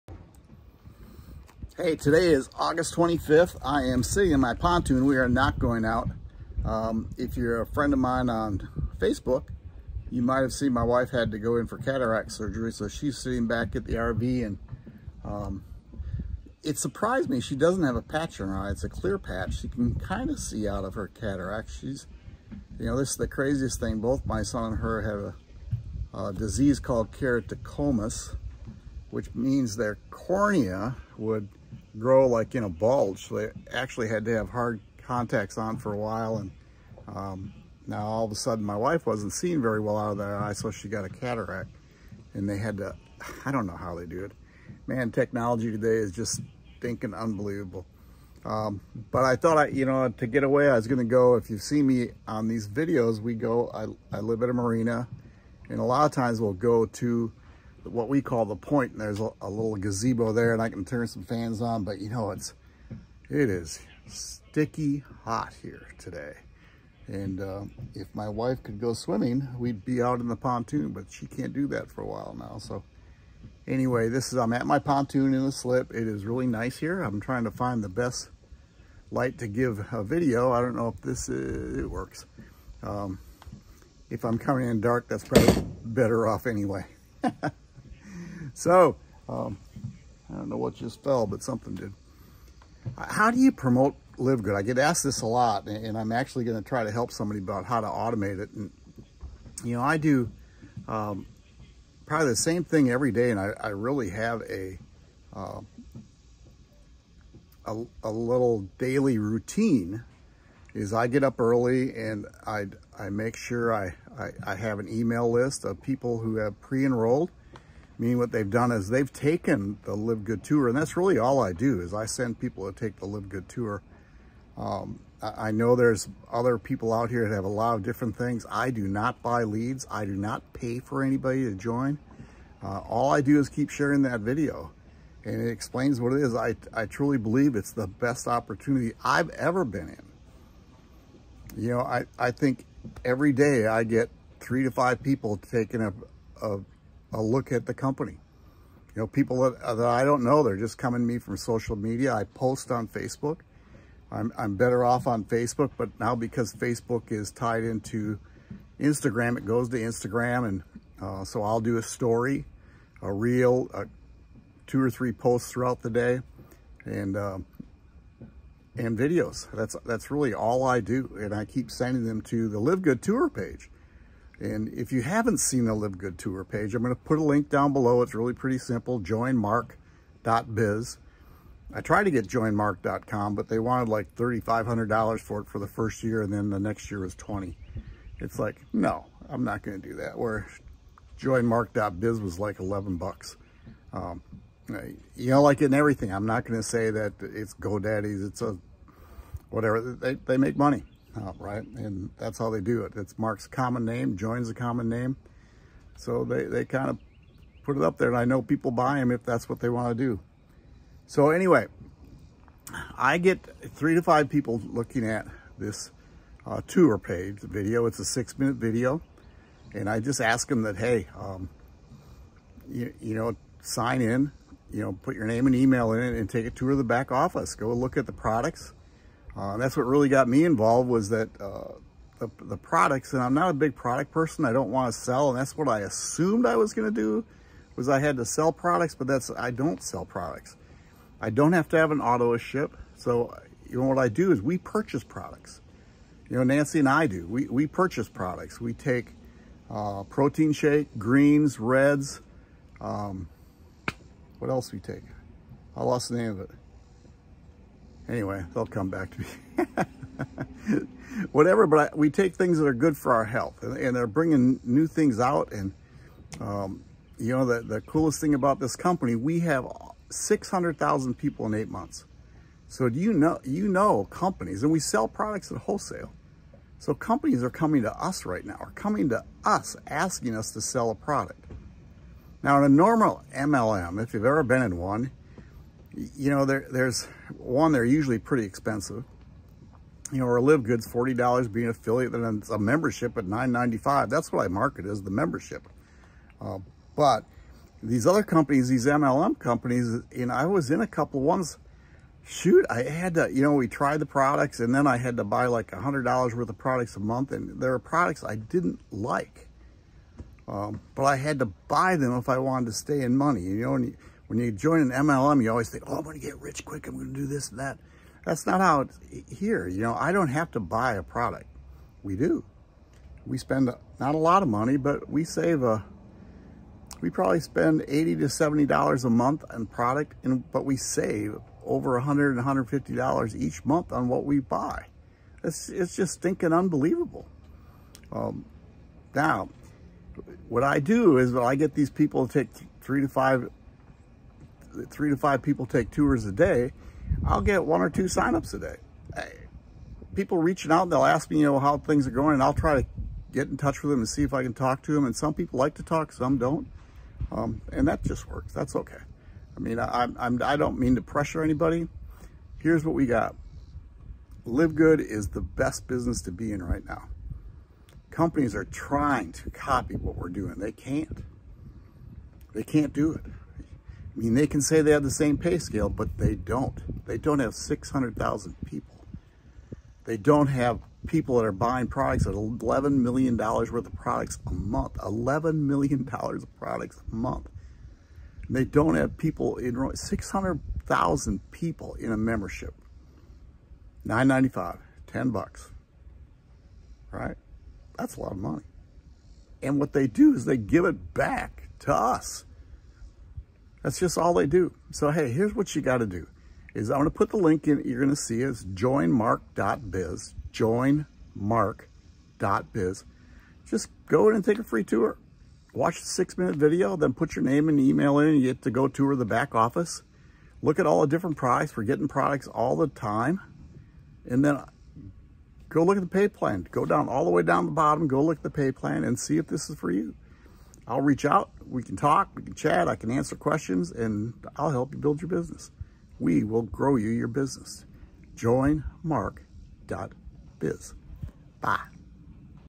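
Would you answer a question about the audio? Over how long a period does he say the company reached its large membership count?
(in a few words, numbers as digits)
8 months.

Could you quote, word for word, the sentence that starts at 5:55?
And some people like to talk, some don't.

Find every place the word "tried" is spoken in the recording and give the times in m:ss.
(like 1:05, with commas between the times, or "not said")
3:01, 5:03.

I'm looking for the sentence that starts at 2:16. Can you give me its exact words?
I, I truly believe it's the best opportunity I've ever been in.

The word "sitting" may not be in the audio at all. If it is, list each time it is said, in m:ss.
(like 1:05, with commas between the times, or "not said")
0:04, 0:13.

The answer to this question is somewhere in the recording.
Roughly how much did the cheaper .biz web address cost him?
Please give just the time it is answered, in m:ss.
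3:12.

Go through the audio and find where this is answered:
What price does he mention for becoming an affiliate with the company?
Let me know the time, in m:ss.
4:50.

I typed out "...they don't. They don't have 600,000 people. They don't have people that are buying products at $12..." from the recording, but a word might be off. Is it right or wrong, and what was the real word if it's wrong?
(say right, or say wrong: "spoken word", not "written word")
wrong: "11", not "12".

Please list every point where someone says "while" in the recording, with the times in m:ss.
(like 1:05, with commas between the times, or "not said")
0:35, 1:12.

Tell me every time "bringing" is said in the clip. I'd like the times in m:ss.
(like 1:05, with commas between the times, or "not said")
4:24.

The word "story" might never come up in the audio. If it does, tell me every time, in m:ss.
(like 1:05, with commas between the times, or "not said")
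2:41.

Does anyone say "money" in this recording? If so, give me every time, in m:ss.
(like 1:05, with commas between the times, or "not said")
3:20, 5:13, 5:24, 6:38.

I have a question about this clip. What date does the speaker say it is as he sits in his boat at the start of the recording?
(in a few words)
August 25th.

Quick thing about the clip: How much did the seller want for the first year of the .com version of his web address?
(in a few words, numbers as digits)
$3,500.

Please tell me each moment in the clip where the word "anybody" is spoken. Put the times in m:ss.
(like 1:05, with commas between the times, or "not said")
2:11, 6:01.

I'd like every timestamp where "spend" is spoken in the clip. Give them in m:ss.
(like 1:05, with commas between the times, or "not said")
5:23, 5:27.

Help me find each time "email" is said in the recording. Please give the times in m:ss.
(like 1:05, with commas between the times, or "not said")
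1:54, 3:45, 6:57.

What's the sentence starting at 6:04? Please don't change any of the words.
Live Good is the best business to be in right now.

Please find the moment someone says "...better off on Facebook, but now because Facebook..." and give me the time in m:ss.
2:34.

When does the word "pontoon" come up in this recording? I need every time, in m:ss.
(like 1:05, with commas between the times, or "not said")
0:04, 1:10, 1:14.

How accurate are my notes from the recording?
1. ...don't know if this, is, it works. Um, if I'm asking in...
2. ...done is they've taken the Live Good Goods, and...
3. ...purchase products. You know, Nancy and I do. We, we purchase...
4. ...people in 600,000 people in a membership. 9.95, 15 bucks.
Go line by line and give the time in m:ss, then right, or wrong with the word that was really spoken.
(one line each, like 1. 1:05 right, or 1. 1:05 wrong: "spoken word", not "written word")
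1. 1:20 wrong: "coming", not "asking"
2. 1:58 wrong: "Tour", not "Goods"
3. 4:04 right
4. 6:29 wrong: "10", not "15".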